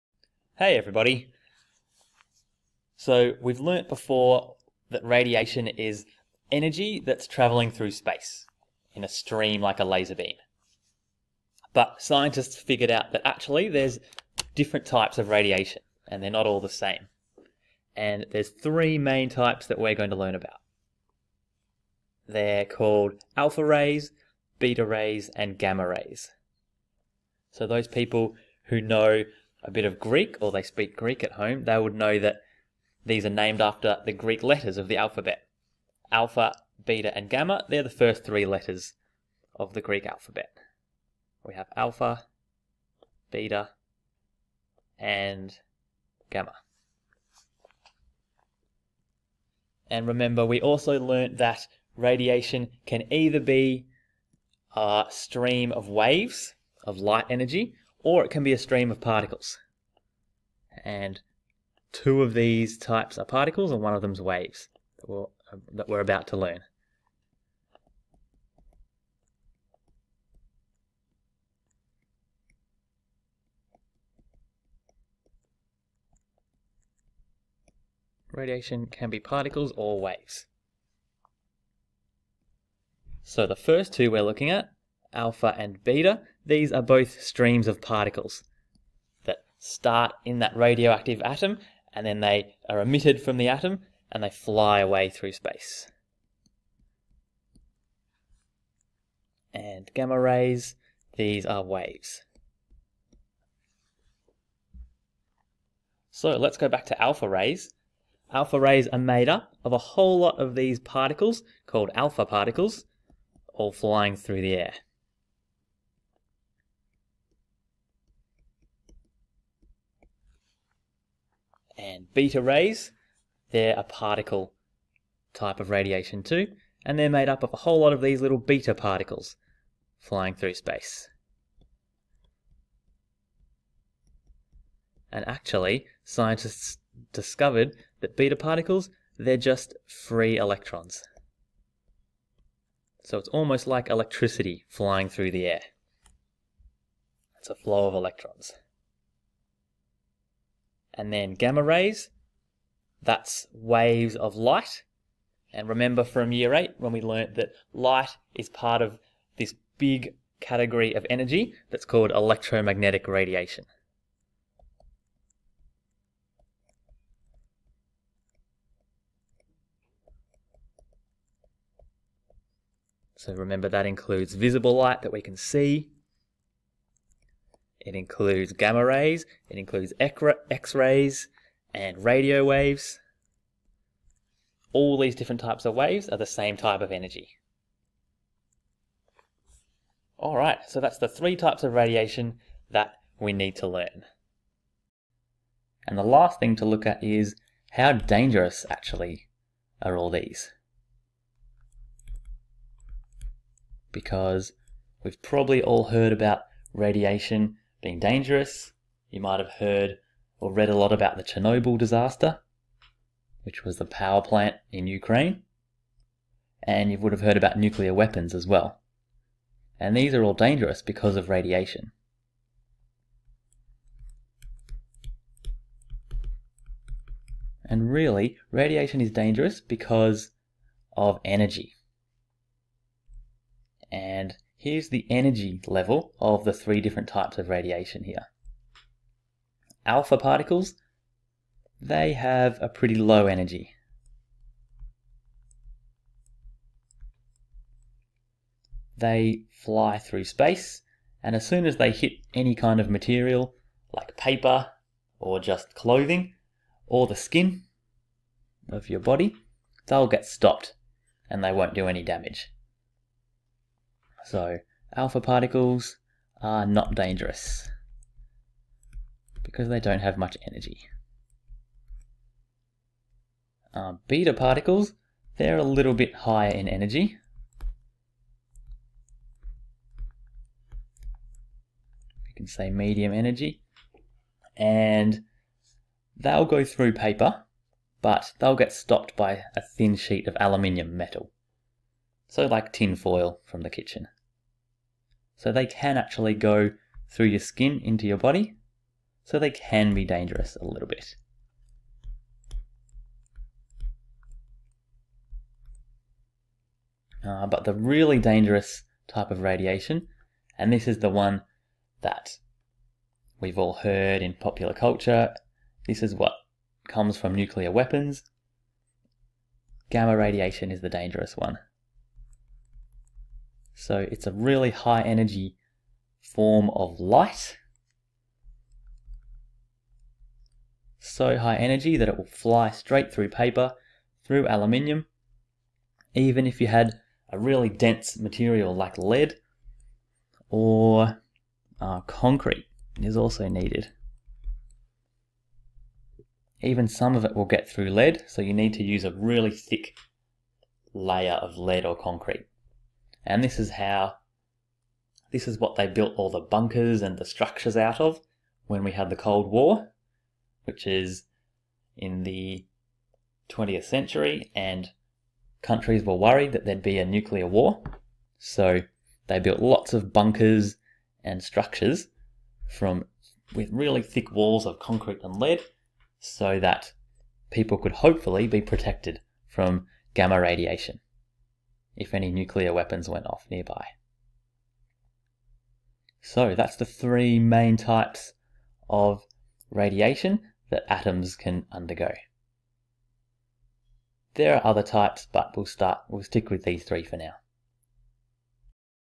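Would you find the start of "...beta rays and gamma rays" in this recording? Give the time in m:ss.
0:24.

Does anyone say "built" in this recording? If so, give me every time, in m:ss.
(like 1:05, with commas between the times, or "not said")
5:55, 6:09.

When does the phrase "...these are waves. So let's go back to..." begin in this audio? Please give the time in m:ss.
1:41.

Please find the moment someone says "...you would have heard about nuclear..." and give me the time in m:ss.
3:36.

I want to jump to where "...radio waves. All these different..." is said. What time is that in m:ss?
3:02.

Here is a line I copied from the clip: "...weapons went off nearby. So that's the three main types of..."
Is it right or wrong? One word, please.
right.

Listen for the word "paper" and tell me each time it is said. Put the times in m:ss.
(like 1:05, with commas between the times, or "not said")
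4:14, 4:46, 5:33.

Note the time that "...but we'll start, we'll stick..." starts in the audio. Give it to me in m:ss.
6:35.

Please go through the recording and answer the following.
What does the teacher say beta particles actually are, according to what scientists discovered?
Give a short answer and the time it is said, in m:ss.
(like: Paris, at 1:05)
free electrons, at 2:19.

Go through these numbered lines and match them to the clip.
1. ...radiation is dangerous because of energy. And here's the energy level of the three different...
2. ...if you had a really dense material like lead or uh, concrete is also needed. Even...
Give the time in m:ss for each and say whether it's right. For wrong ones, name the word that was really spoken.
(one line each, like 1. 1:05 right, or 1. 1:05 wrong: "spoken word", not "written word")
1. 3:48 right
2. 5:36 right.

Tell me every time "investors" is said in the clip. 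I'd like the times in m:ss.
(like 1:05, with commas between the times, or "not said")
not said.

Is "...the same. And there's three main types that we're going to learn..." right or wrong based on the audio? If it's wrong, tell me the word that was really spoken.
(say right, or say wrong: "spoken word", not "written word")
right.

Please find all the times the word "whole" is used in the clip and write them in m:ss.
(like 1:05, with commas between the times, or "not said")
1:49, 2:07.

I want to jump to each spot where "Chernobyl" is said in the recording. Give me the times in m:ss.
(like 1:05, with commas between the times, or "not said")
3:31.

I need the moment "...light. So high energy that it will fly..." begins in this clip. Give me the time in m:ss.
5:26.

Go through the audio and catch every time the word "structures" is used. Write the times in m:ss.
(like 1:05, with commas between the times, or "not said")
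5:57, 6:11.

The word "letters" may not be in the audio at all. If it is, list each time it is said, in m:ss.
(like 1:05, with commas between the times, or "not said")
0:34, 0:38.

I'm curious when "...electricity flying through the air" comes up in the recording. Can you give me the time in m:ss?
2:23.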